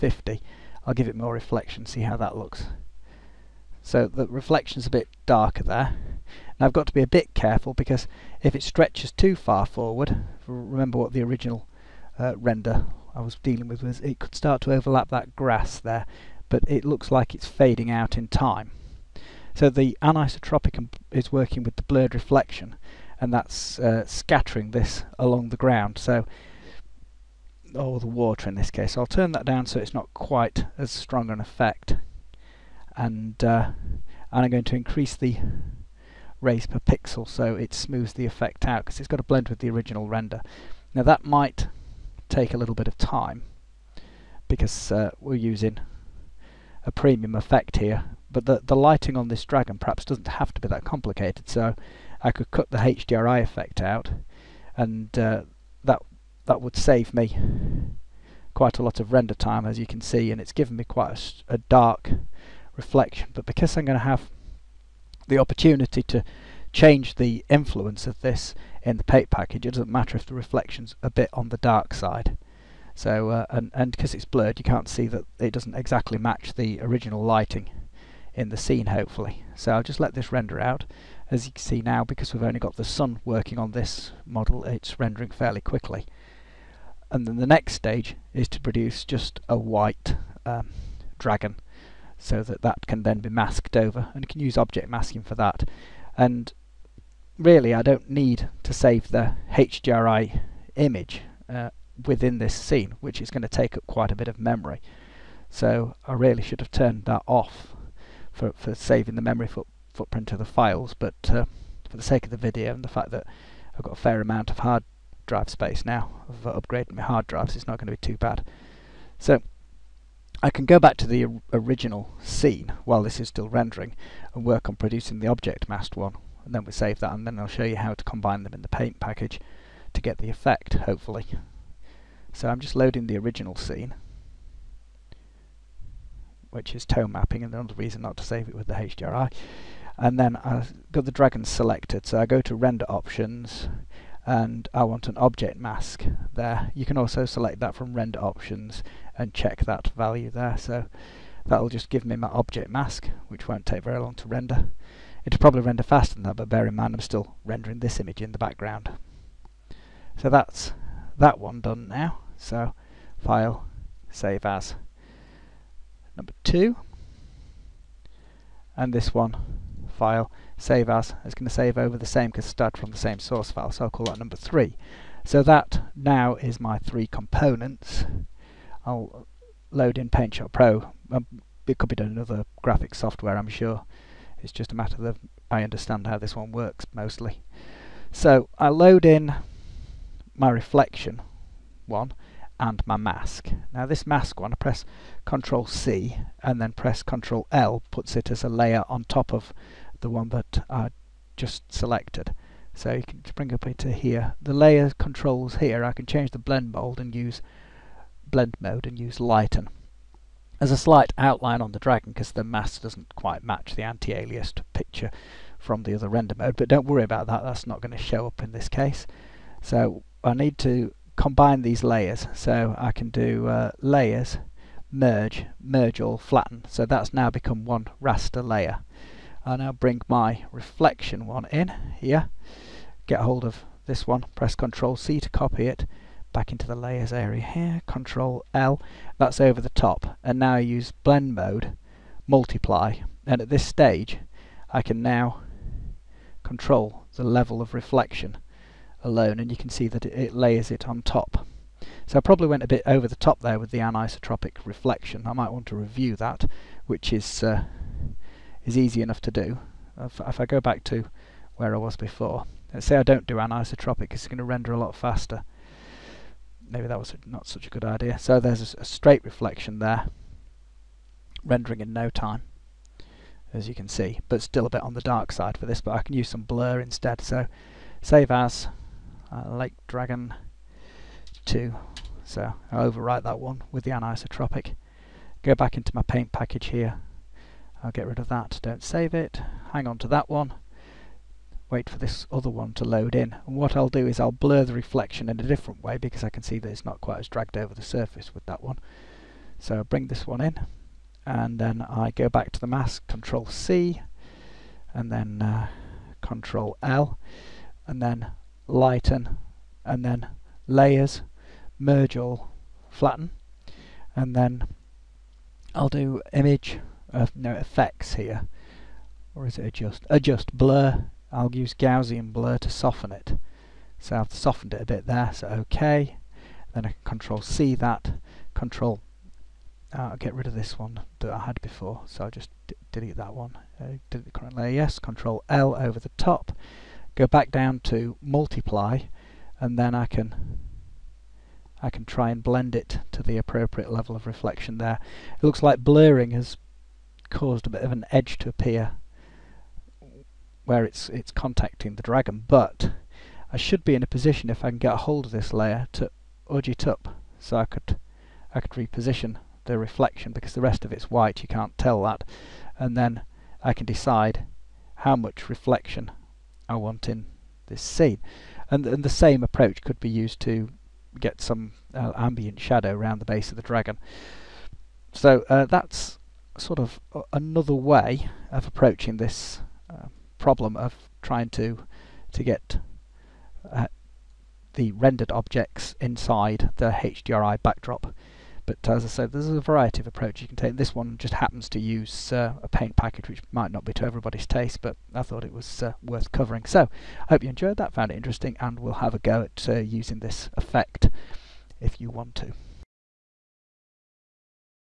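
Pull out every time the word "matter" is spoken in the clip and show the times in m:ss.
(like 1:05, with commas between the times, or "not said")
1:09, 3:04.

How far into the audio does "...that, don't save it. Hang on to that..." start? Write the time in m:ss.
4:48.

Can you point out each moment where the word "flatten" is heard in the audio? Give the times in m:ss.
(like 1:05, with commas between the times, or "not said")
3:46, 5:12.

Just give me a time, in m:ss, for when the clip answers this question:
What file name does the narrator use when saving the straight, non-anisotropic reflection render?
4:39.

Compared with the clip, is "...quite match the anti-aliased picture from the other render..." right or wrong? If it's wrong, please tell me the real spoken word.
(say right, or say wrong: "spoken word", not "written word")
right.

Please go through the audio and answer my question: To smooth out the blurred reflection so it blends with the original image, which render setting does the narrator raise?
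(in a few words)
Rays per pixel.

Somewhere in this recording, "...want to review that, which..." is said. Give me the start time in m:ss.
4:15.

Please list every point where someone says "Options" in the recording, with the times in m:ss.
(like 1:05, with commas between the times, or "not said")
2:22, 2:28.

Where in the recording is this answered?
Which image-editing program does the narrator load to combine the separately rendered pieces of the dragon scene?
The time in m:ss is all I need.
3:00.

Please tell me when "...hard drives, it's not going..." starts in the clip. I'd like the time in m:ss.
1:57.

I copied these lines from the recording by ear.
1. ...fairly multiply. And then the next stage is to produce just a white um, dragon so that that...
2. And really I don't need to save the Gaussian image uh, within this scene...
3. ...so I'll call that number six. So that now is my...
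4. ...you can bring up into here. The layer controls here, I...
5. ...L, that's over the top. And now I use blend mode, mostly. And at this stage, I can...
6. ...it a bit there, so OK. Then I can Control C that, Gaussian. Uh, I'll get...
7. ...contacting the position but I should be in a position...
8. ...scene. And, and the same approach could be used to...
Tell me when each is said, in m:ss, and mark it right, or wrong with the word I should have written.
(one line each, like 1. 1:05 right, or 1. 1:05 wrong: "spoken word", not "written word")
1. 1:25 wrong: "quickly", not "multiply"
2. 1:36 wrong: "HDRI", not "Gaussian"
3. 2:53 wrong: "three", not "six"
4. 3:22 right
5. 3:58 wrong: "multiply", not "mostly"
6. 5:24 wrong: "Control", not "Gaussian"
7. 5:51 wrong: "dragon", not "position"
8. 6:07 right.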